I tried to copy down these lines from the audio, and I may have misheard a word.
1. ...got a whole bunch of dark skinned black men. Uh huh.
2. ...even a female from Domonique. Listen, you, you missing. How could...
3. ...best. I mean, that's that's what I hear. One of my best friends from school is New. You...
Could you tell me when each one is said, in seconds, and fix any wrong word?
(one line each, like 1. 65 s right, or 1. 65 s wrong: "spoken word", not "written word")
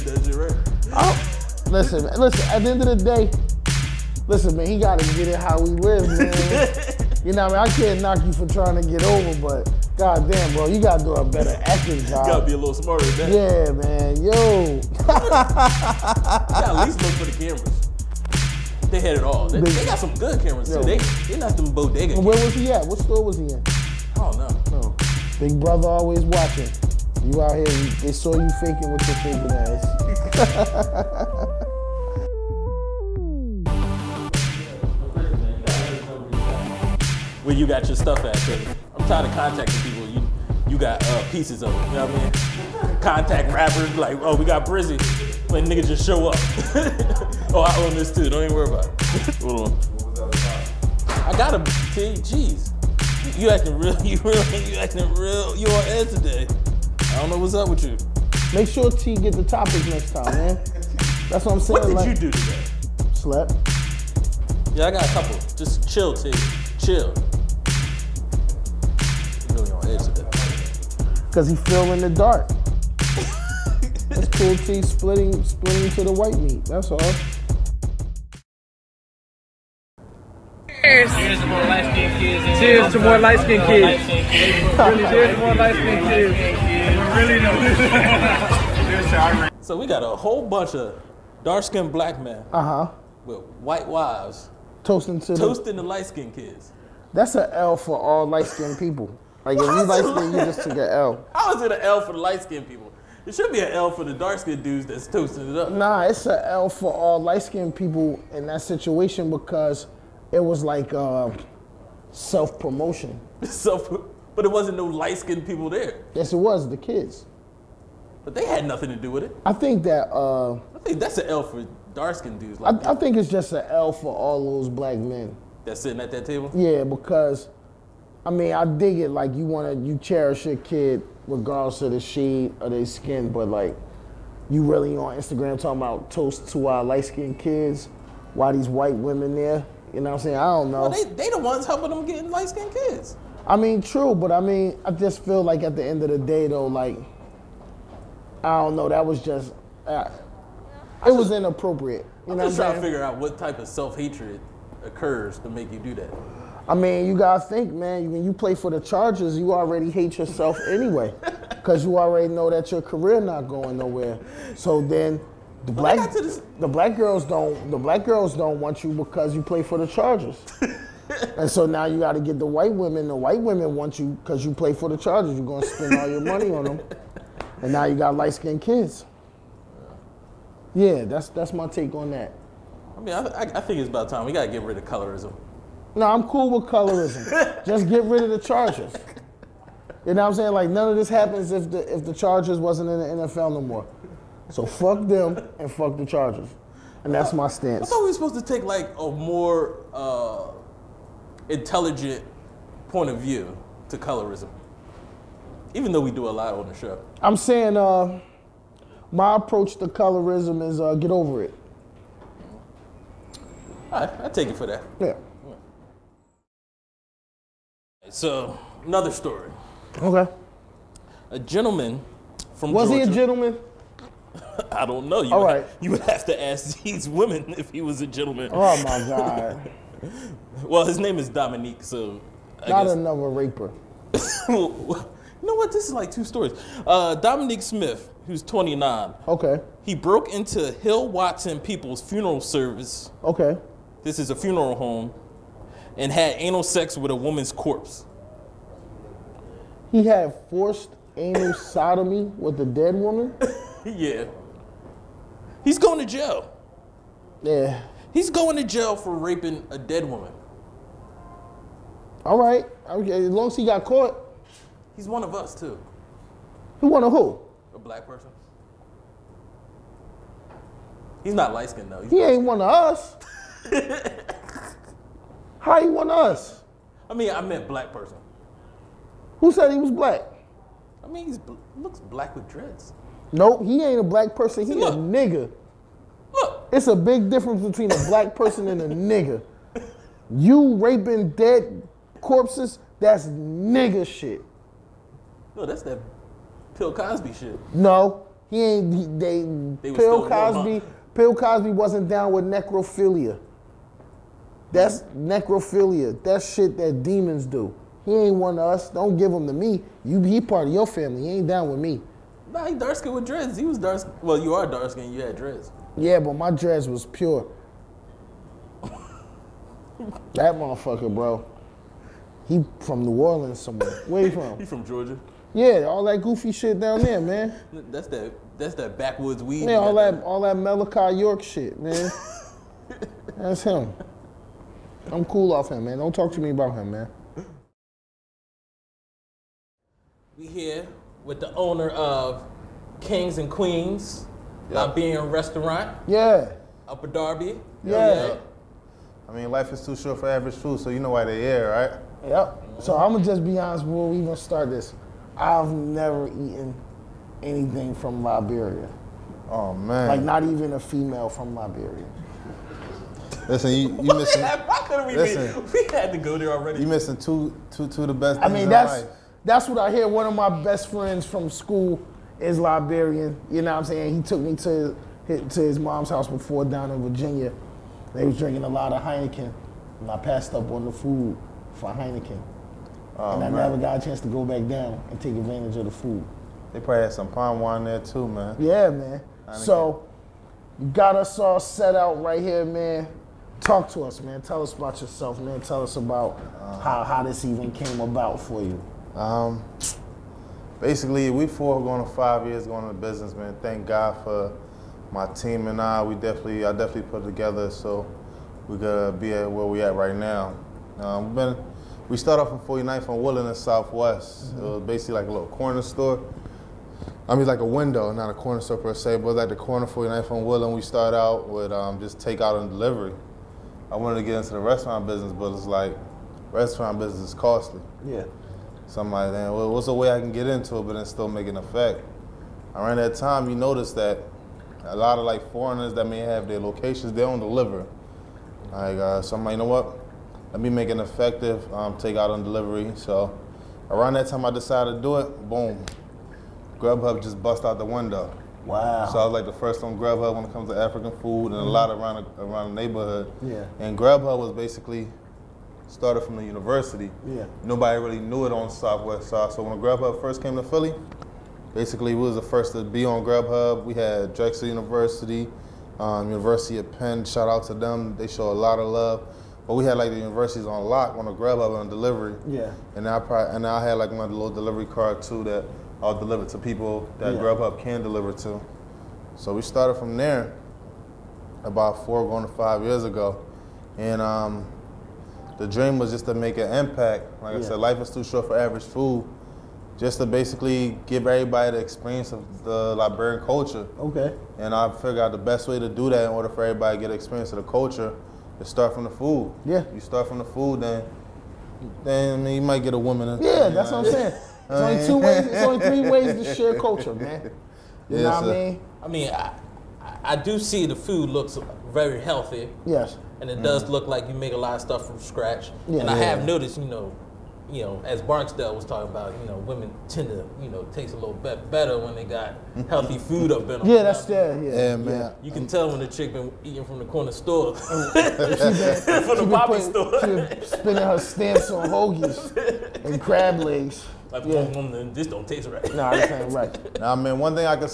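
1. 89 s right
2. 360 s wrong: "Liberia", not "Domonique"
3. 368 s wrong: "Liberian", not "New".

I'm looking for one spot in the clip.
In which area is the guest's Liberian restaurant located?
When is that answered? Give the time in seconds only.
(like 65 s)
346 s.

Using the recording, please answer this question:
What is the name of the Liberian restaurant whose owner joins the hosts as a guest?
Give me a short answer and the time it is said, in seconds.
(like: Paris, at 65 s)
Kings and Queens, at 342 s.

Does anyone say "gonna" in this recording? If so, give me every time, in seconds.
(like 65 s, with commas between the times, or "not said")
175 s, 353 s.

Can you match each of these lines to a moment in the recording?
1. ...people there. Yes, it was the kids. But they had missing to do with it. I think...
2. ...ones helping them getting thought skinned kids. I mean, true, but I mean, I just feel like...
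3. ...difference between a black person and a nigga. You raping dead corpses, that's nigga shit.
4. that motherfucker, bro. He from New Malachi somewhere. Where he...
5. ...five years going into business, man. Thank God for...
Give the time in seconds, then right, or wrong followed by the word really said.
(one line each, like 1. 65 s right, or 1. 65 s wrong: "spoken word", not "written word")
1. 115 s wrong: "nothing", not "missing"
2. 141 s wrong: "light", not "thought"
3. 287 s right
4. 319 s wrong: "Orleans", not "Malachi"
5. 402 s right.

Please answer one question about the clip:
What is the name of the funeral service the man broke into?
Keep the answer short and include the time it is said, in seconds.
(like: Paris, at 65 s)
Hill Watson People's funeral service, at 240 s.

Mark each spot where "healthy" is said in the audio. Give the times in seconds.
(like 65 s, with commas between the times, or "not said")
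512 s, 522 s.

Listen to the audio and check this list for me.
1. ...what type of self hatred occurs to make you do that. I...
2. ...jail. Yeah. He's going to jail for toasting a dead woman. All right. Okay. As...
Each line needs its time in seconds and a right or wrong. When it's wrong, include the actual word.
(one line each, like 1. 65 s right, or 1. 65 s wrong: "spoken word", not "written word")
1. 153 s right
2. 256 s wrong: "raping", not "toasting".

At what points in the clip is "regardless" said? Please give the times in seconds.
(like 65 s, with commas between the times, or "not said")
131 s.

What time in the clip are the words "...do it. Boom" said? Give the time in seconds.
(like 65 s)
445 s.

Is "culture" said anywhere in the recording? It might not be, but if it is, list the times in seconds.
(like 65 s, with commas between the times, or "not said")
493 s, 497 s, 506 s.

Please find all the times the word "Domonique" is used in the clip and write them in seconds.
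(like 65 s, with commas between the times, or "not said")
231 s, 237 s.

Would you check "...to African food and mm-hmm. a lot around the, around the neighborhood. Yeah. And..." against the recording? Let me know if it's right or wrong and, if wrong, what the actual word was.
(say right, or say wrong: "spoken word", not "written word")
right.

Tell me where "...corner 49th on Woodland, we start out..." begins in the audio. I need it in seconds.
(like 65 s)
419 s.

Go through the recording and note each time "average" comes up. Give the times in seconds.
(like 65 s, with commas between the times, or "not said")
350 s, 488 s.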